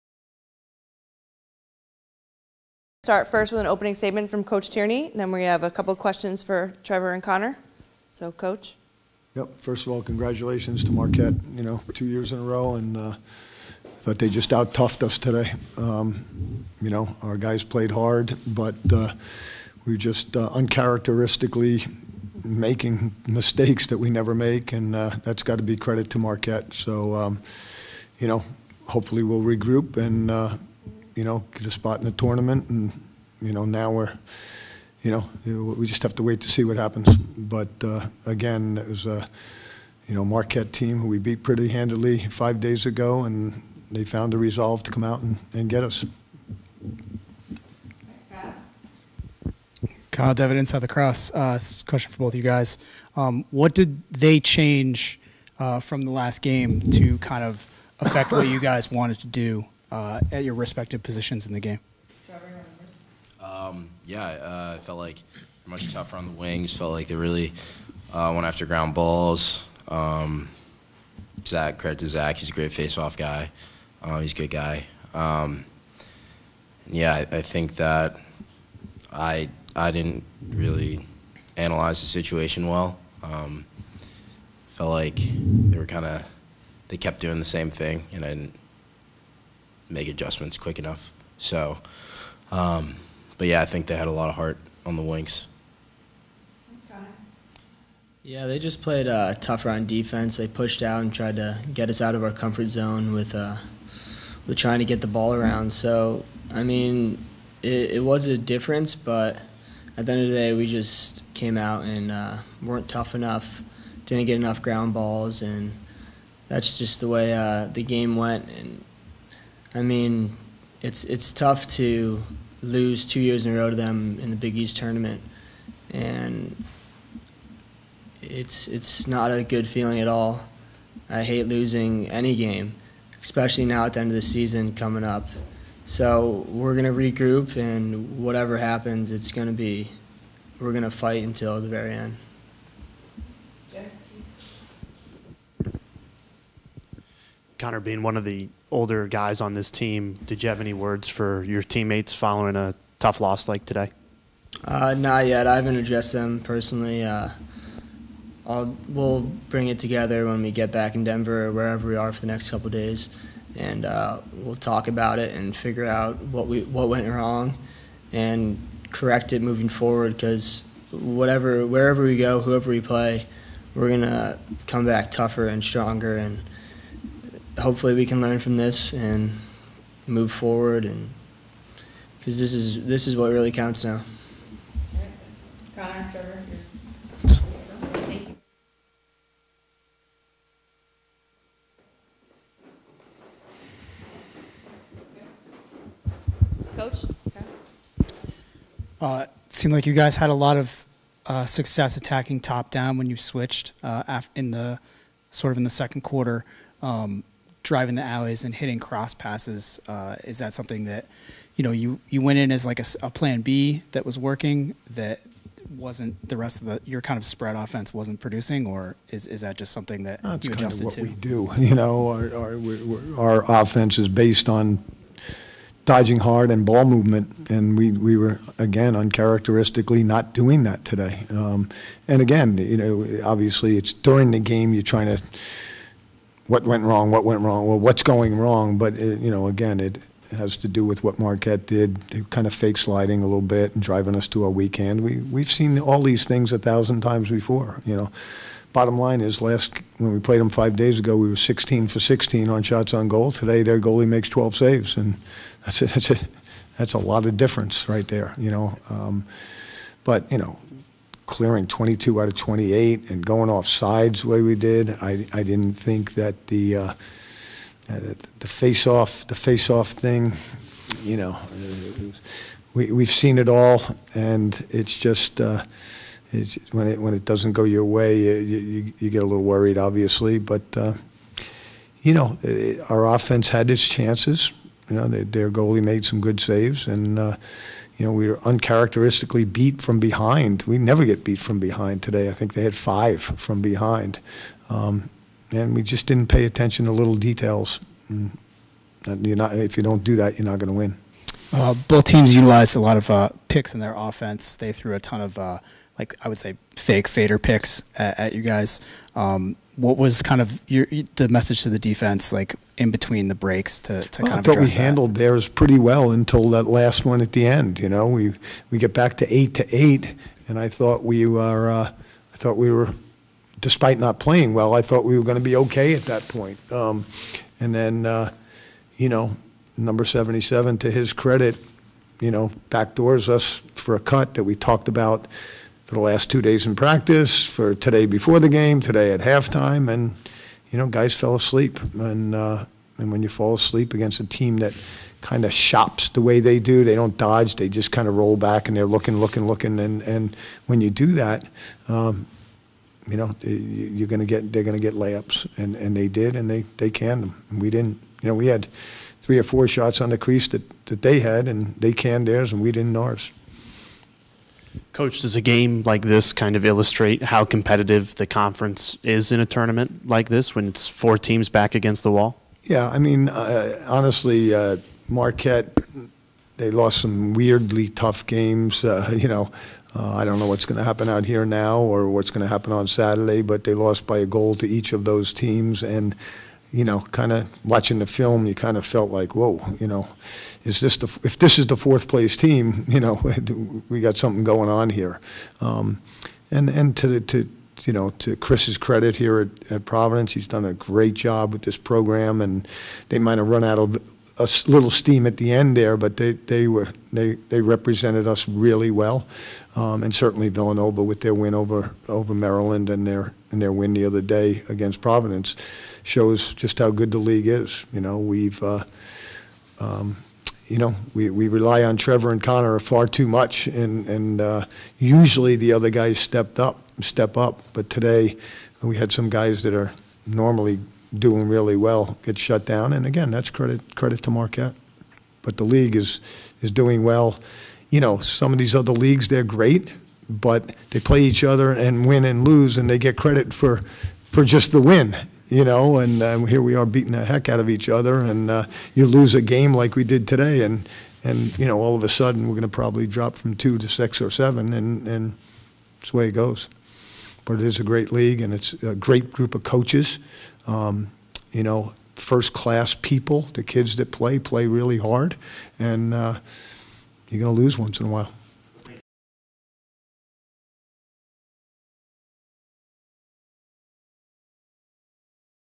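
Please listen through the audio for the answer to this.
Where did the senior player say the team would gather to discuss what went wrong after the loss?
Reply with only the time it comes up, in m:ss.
2:41.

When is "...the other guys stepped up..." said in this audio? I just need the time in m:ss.
7:05.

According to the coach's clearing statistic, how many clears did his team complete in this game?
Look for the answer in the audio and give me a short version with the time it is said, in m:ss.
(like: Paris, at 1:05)
22 out of 28, at 4:21.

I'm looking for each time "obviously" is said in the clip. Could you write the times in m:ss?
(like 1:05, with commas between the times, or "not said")
3:53, 4:39.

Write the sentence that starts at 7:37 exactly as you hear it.
But it is a great league, and it's a great group of coaches.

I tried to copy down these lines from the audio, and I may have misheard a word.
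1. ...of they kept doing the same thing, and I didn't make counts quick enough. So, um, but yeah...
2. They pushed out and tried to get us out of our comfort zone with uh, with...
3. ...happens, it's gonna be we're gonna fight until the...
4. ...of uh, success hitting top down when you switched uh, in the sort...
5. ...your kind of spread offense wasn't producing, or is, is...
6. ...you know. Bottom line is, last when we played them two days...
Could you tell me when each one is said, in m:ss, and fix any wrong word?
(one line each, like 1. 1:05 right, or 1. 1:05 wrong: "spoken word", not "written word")
1. 1:26 wrong: "adjustments", not "counts"
2. 1:40 right
3. 2:18 right
4. 3:20 wrong: "attacking", not "hitting"
5. 3:36 right
6. 4:07 wrong: "five", not "two".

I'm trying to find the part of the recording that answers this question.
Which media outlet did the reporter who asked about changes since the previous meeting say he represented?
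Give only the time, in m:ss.
0:50.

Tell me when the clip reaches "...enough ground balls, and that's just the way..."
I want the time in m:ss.
1:54.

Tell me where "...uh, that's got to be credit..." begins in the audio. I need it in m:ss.
0:24.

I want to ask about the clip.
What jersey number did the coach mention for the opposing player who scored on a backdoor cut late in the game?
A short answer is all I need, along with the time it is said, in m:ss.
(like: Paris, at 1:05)
77, at 5:30.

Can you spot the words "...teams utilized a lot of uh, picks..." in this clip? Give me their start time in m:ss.
5:02.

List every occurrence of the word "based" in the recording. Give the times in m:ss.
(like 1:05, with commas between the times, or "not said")
3:44.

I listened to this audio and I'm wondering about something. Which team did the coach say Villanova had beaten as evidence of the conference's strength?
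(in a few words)
Maryland.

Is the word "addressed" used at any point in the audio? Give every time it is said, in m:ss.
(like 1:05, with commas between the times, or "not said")
2:35.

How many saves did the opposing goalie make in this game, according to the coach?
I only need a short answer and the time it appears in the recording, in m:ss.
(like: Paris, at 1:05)
12, at 4:14.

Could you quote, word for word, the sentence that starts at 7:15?
But the league is is doing well.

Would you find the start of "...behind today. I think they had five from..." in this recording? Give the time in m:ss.
4:51.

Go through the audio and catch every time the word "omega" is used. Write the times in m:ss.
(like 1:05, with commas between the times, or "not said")
not said.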